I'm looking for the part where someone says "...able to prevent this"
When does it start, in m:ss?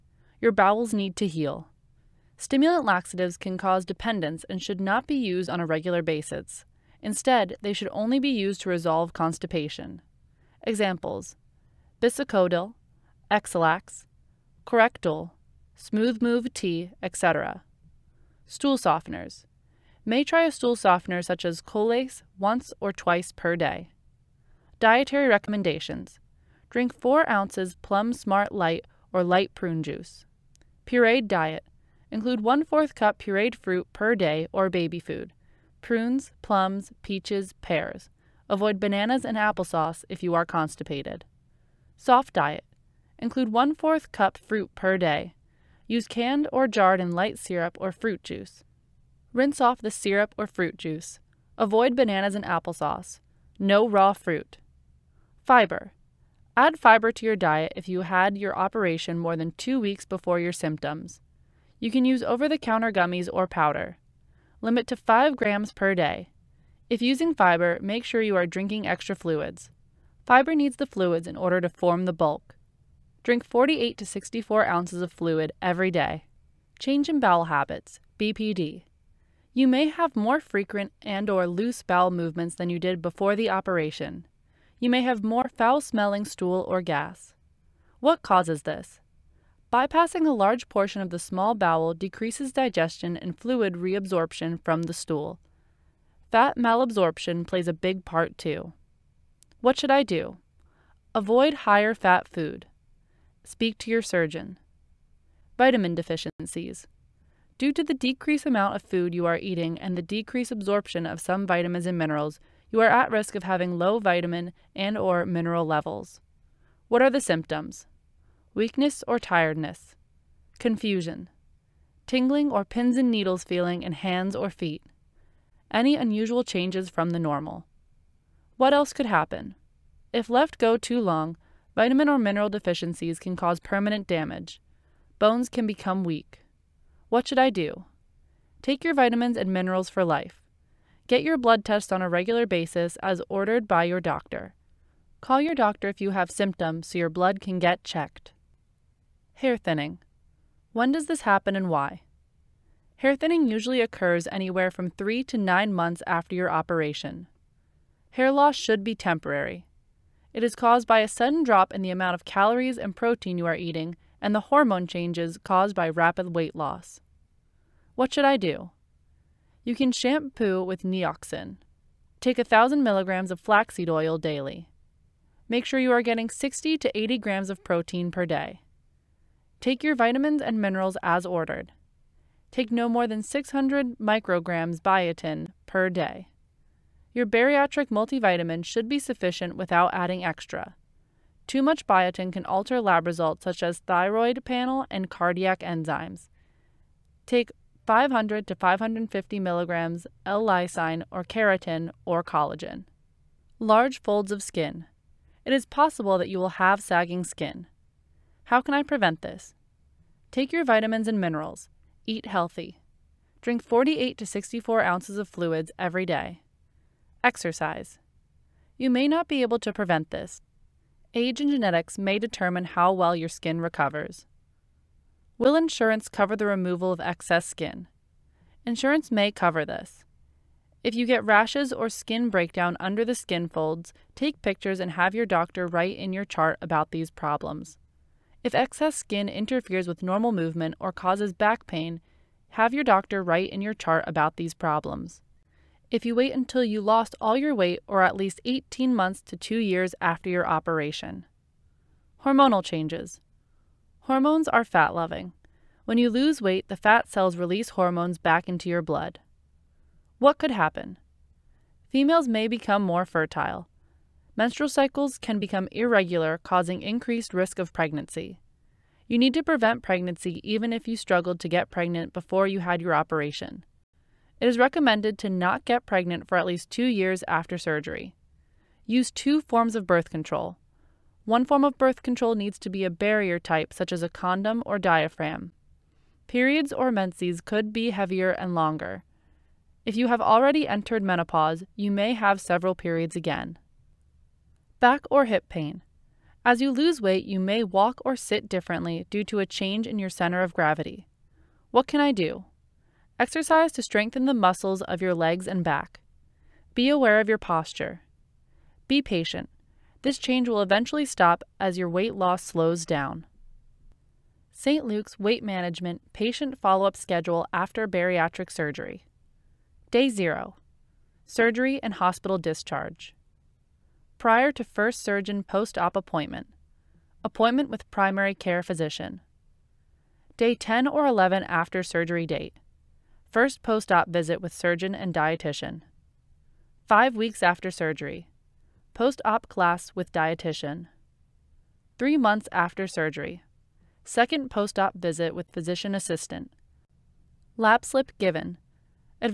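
3:39.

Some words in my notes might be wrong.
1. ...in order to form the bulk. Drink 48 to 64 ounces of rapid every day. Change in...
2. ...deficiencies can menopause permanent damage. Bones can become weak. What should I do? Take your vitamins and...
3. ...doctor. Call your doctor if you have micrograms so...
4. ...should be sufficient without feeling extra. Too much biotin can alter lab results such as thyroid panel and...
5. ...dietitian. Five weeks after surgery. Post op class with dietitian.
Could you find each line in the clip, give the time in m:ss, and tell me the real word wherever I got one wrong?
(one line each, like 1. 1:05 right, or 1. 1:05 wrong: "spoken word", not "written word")
1. 1:11 wrong: "fluid", not "rapid"
2. 2:12 wrong: "cause", not "menopause"
3. 2:24 wrong: "symptoms", not "micrograms"
4. 3:08 wrong: "adding", not "feeling"
5. 5:35 right.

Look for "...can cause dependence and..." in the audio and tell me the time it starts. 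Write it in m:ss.
0:03.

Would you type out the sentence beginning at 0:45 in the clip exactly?
Use canned or jarred in light syrup or fruit juice.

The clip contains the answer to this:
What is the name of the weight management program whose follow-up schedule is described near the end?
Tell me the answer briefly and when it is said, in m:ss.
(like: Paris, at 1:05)
St. Luke's, at 5:14.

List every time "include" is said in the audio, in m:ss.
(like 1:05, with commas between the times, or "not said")
0:32, 0:43.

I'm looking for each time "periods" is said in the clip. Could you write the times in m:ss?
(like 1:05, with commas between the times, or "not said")
4:46, 4:52.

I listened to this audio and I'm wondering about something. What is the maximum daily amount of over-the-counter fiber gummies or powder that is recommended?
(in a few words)
5 grams.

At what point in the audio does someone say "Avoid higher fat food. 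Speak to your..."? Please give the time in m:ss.
1:41.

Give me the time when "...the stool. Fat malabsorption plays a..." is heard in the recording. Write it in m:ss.
1:34.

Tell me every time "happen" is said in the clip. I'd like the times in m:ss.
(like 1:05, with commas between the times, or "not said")
2:09, 2:31, 4:20.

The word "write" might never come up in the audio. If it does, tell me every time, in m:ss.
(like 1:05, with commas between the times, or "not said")
3:55, 4:03.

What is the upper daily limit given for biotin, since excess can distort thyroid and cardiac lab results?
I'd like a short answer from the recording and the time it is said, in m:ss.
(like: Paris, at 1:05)
600 micrograms, at 3:03.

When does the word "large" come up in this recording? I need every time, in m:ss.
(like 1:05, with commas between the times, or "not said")
1:30, 3:23.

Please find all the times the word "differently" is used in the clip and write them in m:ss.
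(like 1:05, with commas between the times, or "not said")
4:58.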